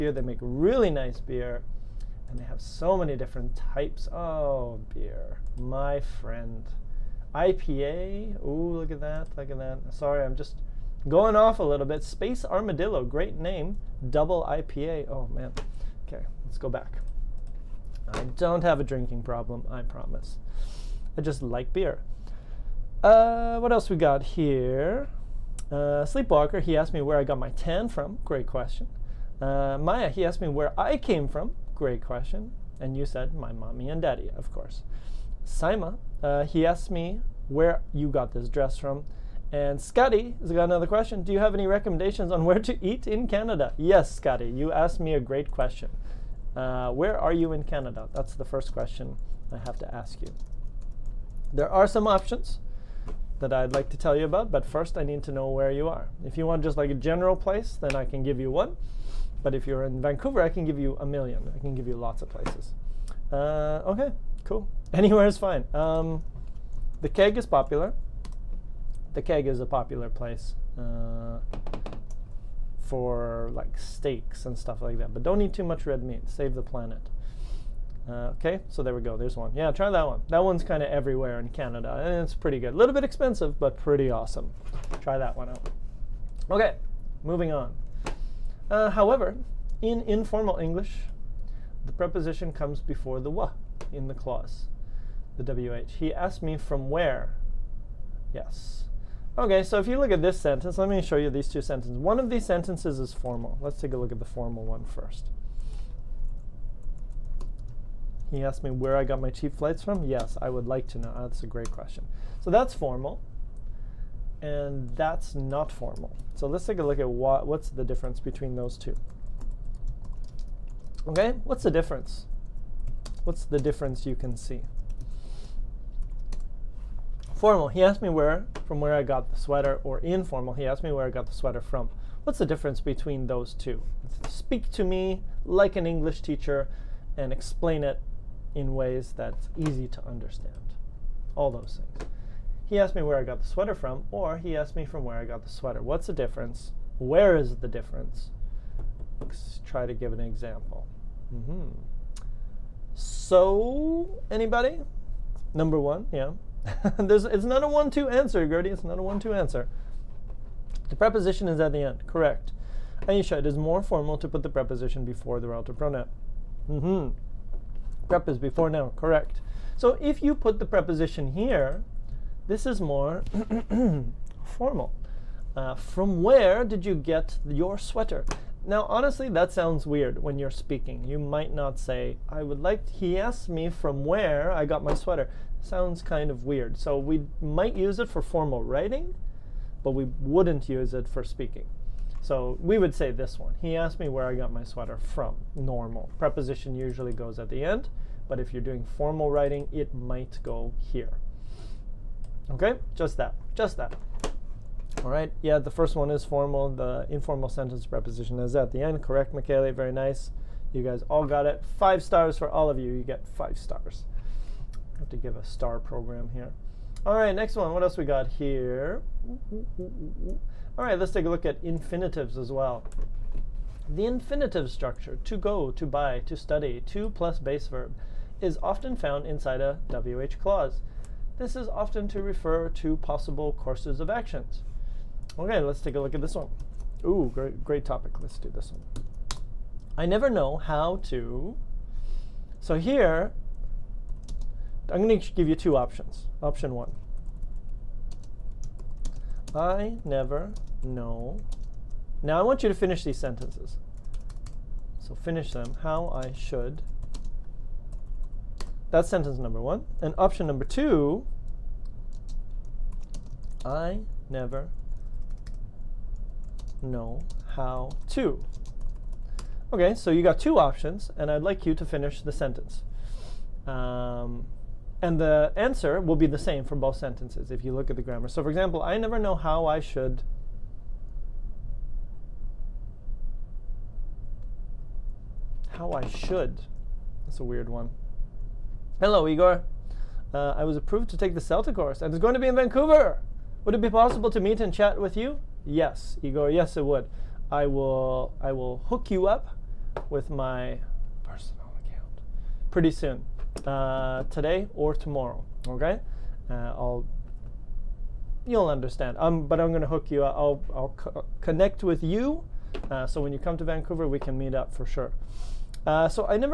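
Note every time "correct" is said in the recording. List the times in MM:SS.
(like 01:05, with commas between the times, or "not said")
02:42, 02:48, 03:29.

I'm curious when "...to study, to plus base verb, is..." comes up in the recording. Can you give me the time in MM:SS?
03:46.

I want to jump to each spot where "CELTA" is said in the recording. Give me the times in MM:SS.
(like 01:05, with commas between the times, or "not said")
04:51.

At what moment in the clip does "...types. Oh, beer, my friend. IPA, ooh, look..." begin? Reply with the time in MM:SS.
00:03.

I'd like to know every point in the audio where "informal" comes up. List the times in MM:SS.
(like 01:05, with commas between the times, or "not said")
01:30, 02:09, 03:27.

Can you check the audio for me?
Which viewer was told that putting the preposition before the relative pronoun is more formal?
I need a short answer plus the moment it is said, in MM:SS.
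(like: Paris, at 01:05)
Aisha, at 02:43.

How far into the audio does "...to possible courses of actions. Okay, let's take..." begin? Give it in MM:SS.
03:52.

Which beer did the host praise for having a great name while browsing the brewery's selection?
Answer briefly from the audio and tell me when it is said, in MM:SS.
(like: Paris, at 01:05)
Space Armadillo, at 00:12.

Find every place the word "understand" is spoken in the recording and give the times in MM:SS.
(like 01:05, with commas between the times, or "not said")
02:20, 05:08.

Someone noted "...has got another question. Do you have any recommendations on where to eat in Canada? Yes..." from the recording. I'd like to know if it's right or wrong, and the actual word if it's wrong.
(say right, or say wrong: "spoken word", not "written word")
right.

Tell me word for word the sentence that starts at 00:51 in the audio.
There are some options that I'd like to tell you about, but first I need to know where you are.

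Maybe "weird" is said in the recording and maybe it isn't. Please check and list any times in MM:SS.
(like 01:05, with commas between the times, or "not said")
02:59, 03:06, 04:47.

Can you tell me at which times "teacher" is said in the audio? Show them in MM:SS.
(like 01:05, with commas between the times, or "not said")
02:16.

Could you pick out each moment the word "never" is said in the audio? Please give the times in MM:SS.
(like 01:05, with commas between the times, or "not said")
04:00, 04:10, 04:24, 04:38.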